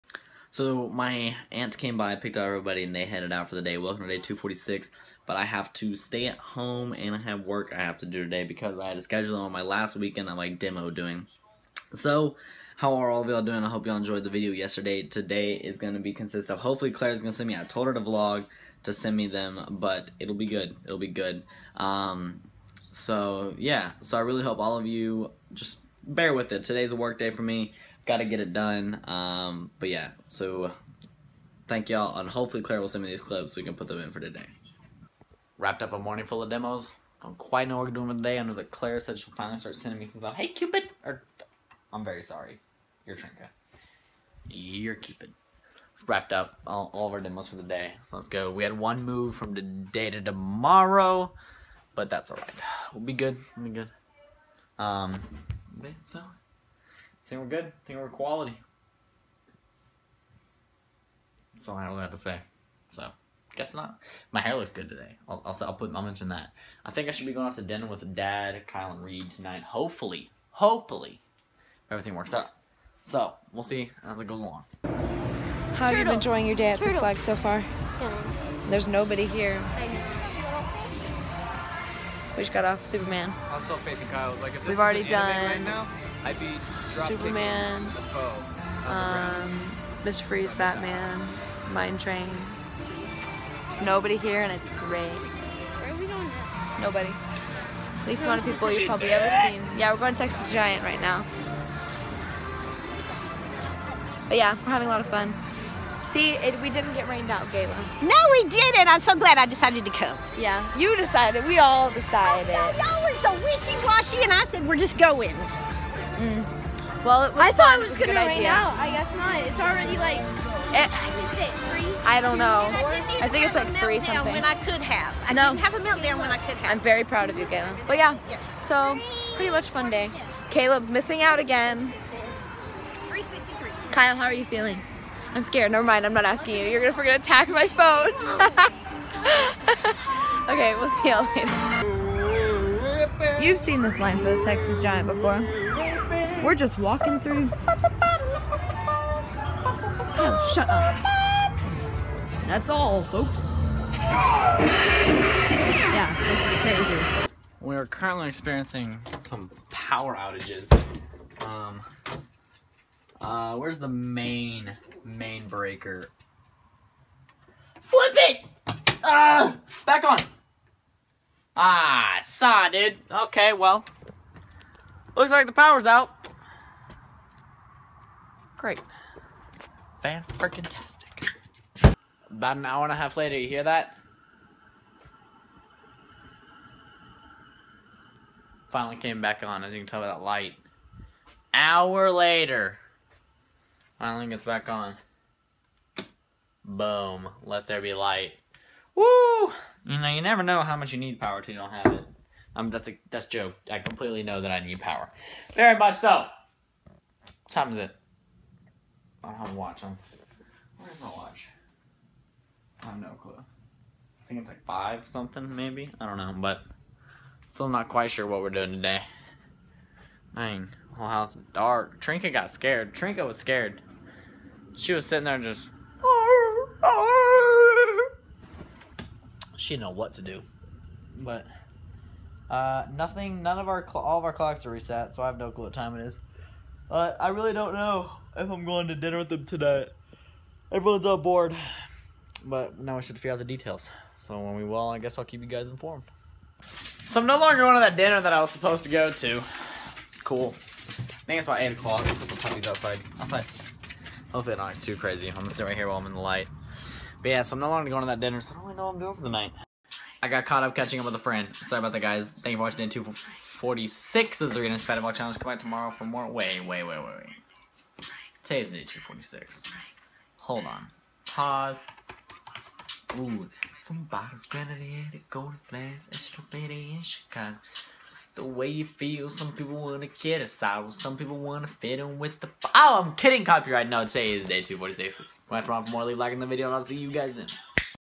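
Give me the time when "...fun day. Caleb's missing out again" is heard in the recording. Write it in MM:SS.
02:09.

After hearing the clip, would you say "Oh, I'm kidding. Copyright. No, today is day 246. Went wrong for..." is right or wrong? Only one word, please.
right.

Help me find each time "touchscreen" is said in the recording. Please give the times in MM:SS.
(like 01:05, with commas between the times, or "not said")
not said.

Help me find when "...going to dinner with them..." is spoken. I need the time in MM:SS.
03:58.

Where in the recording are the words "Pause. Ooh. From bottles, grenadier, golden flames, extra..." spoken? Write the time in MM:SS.
04:31.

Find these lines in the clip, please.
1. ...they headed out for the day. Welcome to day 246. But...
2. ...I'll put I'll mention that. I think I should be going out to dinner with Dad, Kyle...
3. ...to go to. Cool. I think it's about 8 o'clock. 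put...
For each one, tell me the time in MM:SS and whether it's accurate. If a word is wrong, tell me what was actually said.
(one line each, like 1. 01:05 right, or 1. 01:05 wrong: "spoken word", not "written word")
1. 00:02 right
2. 01:05 right
3. 04:08 right.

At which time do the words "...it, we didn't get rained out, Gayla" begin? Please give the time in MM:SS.
01:46.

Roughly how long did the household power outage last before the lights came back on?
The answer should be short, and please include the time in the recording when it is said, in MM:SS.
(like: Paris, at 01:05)
An hour and a half, at 03:02.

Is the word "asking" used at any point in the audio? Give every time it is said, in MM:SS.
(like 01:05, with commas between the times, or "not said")
02:16.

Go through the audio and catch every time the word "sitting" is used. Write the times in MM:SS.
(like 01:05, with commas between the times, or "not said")
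03:45.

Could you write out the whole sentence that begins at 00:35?
Wrapped up a morning full of demos.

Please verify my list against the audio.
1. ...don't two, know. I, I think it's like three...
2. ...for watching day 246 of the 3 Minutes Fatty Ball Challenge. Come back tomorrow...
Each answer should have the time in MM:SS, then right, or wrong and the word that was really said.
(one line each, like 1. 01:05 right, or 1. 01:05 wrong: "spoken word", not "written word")
1. 02:02 right
2. 04:22 right.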